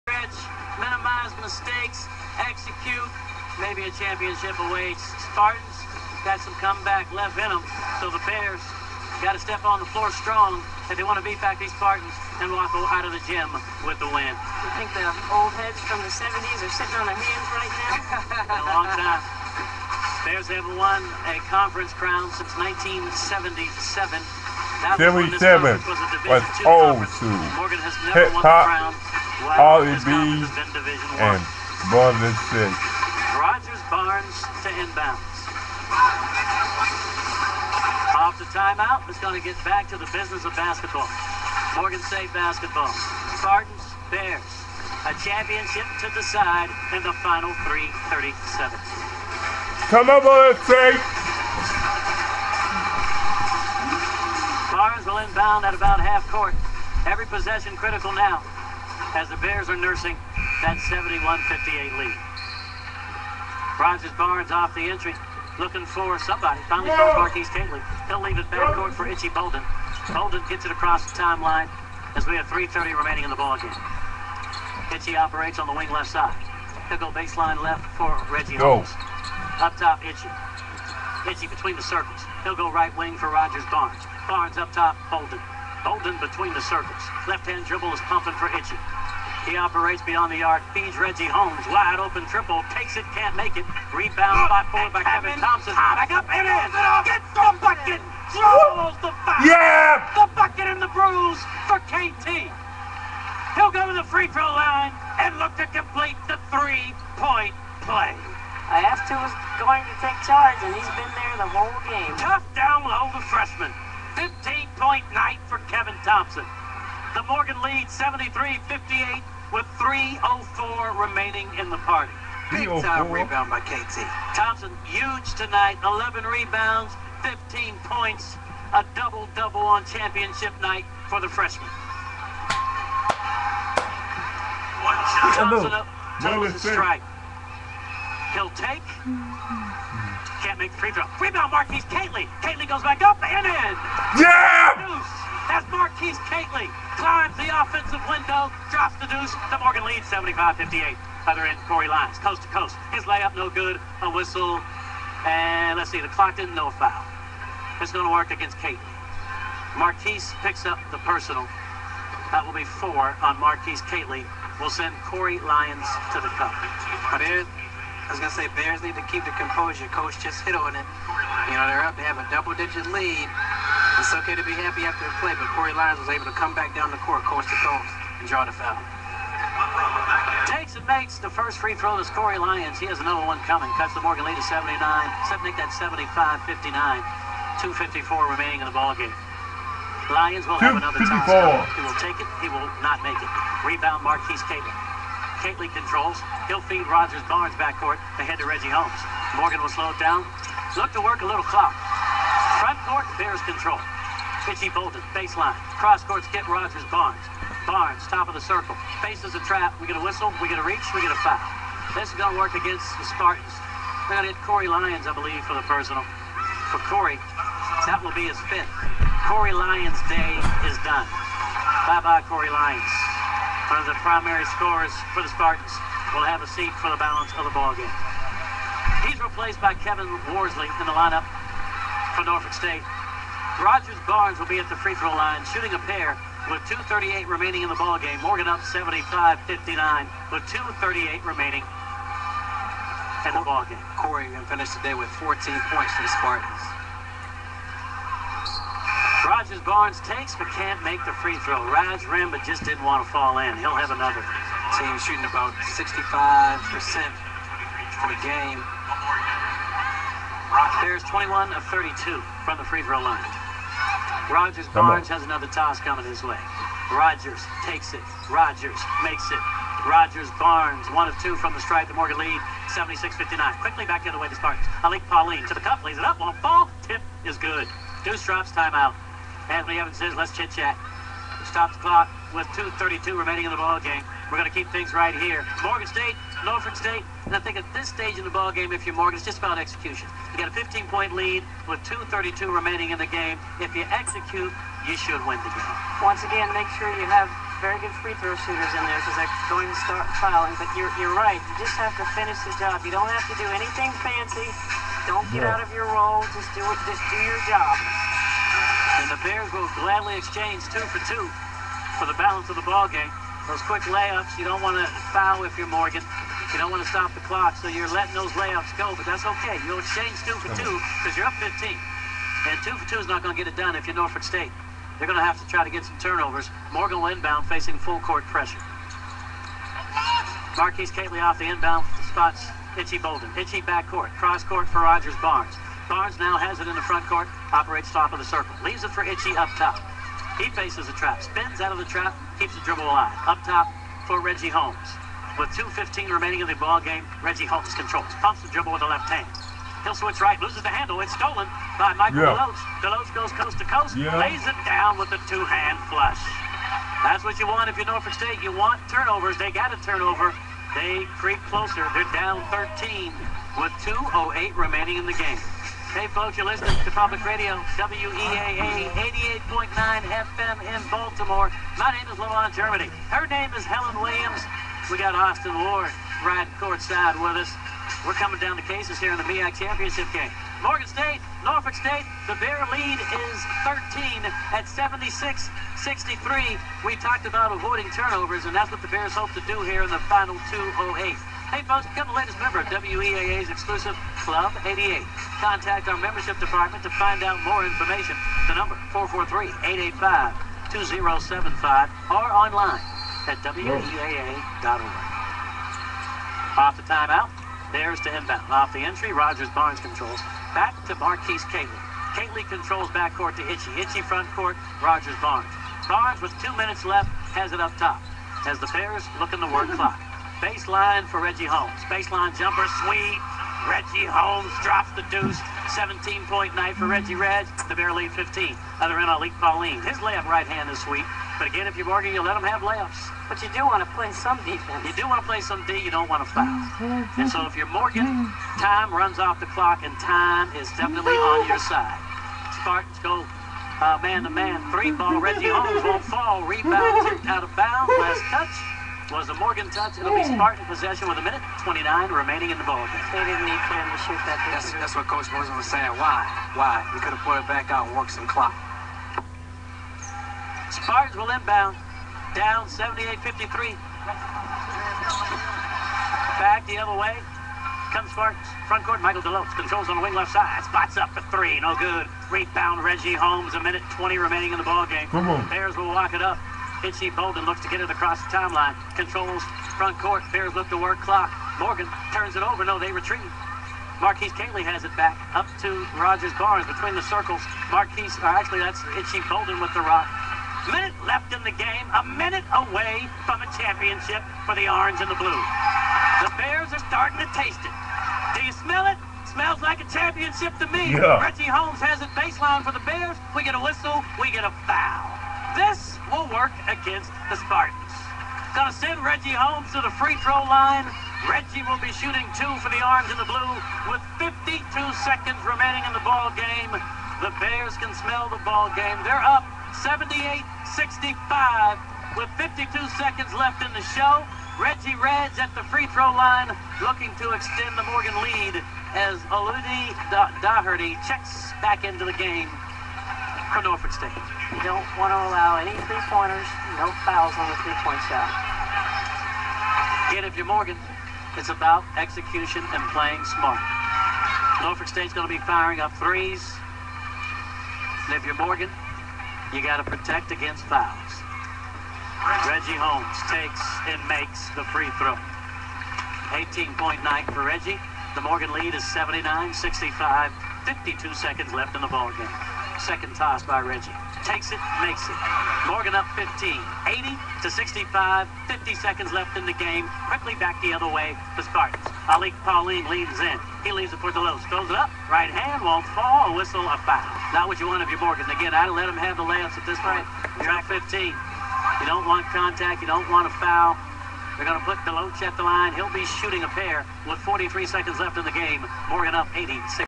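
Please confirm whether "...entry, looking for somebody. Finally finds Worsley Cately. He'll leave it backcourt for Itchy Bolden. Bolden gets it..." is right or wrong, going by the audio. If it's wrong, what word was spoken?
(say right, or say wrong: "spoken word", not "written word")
wrong: "Marquise", not "Worsley".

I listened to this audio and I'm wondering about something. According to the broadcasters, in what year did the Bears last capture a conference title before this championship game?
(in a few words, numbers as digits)
1977.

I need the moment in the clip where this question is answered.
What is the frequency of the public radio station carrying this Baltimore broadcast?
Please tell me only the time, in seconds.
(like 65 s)
368 s.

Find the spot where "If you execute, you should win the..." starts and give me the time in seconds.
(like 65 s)
293 s.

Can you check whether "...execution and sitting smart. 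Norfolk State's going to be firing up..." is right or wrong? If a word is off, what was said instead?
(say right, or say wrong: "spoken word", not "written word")
wrong: "playing", not "sitting".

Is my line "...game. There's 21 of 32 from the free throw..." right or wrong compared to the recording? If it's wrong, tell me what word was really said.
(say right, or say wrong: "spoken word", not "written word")
right.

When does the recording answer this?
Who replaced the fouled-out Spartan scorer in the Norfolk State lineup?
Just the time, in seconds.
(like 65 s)
229 s.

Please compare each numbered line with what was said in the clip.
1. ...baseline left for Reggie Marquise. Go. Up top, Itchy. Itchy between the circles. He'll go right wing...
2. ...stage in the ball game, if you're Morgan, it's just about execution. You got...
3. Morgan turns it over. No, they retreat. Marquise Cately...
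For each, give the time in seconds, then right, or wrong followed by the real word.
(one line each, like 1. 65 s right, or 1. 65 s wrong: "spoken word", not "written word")
1. 77 s wrong: "Holmes", not "Marquise"
2. 287 s right
3. 481 s right.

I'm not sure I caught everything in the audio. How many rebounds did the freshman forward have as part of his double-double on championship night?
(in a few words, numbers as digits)
11.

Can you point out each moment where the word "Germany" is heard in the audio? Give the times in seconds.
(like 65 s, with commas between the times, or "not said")
372 s.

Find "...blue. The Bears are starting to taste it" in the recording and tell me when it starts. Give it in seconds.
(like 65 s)
495 s.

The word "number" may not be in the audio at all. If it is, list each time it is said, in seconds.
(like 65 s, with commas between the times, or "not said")
398 s.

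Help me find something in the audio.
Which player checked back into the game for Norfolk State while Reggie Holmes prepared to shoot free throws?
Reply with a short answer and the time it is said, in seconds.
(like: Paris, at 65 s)
Aludi Doherty, at 529 s.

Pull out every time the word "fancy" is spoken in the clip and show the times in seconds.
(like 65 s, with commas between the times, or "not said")
304 s.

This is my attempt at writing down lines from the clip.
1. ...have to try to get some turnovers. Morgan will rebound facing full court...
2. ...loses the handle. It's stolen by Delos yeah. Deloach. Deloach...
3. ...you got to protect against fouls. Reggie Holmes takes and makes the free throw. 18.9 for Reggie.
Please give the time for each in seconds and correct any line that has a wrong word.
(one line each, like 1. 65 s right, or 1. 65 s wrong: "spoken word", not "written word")
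1. 325 s wrong: "inbound", not "rebound"
2. 350 s wrong: "Michael", not "Delos"
3. 549 s right.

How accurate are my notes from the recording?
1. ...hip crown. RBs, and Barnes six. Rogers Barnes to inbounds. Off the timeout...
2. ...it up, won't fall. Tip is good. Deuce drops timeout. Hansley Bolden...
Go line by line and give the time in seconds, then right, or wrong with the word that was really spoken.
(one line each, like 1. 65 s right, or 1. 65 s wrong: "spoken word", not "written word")
1. 28 s right
2. 275 s wrong: "Evans", not "Bolden".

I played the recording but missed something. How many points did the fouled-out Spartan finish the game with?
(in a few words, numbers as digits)
14.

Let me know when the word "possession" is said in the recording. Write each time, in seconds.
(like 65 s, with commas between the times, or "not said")
57 s, 450 s.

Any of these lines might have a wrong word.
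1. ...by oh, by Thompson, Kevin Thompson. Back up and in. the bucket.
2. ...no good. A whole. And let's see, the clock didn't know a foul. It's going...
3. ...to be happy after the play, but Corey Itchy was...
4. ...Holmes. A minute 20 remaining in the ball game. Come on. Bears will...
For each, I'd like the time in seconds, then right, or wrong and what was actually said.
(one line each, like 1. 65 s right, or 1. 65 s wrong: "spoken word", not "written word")
1. 94 s wrong: "Kevin", not "Thompson"
2. 153 s wrong: "whistle", not "whole"
3. 174 s wrong: "Lyons", not "Itchy"
4. 473 s right.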